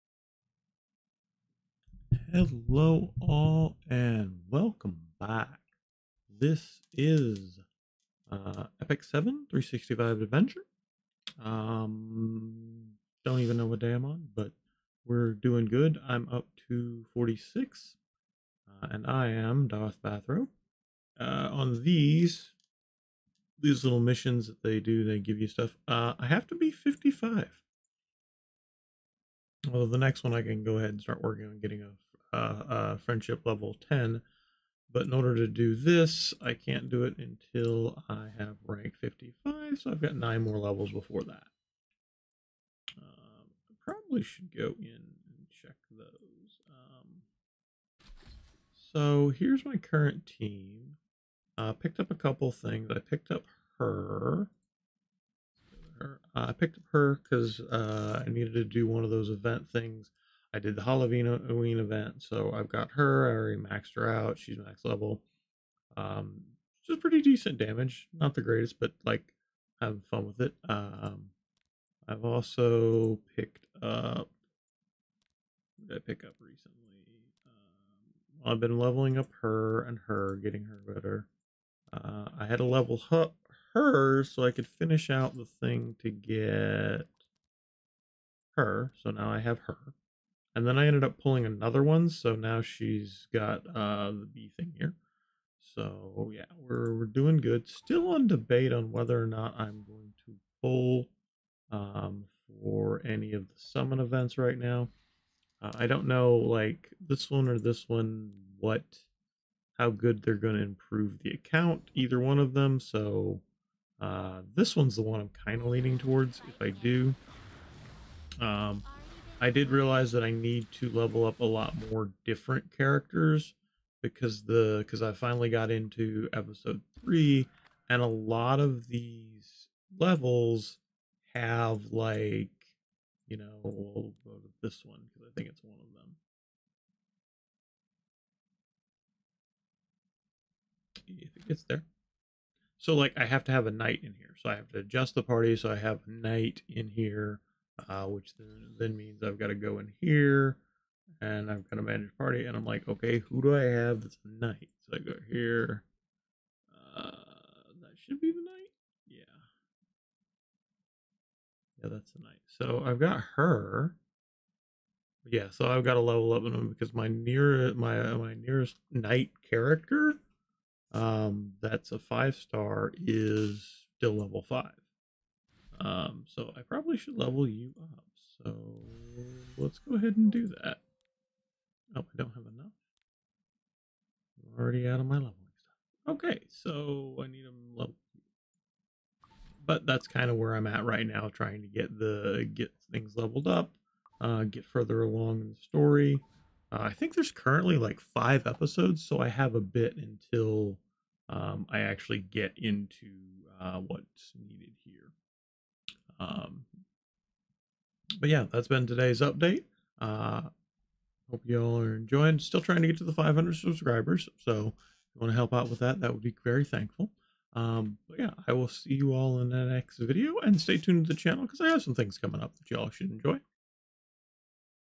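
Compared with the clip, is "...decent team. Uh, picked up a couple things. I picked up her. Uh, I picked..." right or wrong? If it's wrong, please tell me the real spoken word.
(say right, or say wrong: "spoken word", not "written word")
wrong: "current", not "decent".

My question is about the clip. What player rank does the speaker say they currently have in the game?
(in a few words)
46.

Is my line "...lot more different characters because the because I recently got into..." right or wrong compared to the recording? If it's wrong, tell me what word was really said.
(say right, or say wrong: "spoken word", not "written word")
wrong: "finally", not "recently".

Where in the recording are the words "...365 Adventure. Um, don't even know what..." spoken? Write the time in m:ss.
0:09.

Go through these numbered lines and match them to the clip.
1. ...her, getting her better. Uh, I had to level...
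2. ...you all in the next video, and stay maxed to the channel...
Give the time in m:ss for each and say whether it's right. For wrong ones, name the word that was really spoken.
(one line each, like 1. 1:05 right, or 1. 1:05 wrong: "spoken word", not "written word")
1. 1:20 right
2. 3:38 wrong: "tuned", not "maxed".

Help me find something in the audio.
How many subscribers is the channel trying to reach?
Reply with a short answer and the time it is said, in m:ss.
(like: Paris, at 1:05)
500, at 3:33.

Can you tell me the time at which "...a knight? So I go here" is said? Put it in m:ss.
2:34.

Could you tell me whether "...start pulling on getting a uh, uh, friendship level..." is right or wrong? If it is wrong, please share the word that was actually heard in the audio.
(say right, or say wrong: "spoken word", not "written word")
wrong: "working", not "pulling".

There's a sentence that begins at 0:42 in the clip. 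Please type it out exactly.
Um, I probably should go in and check those.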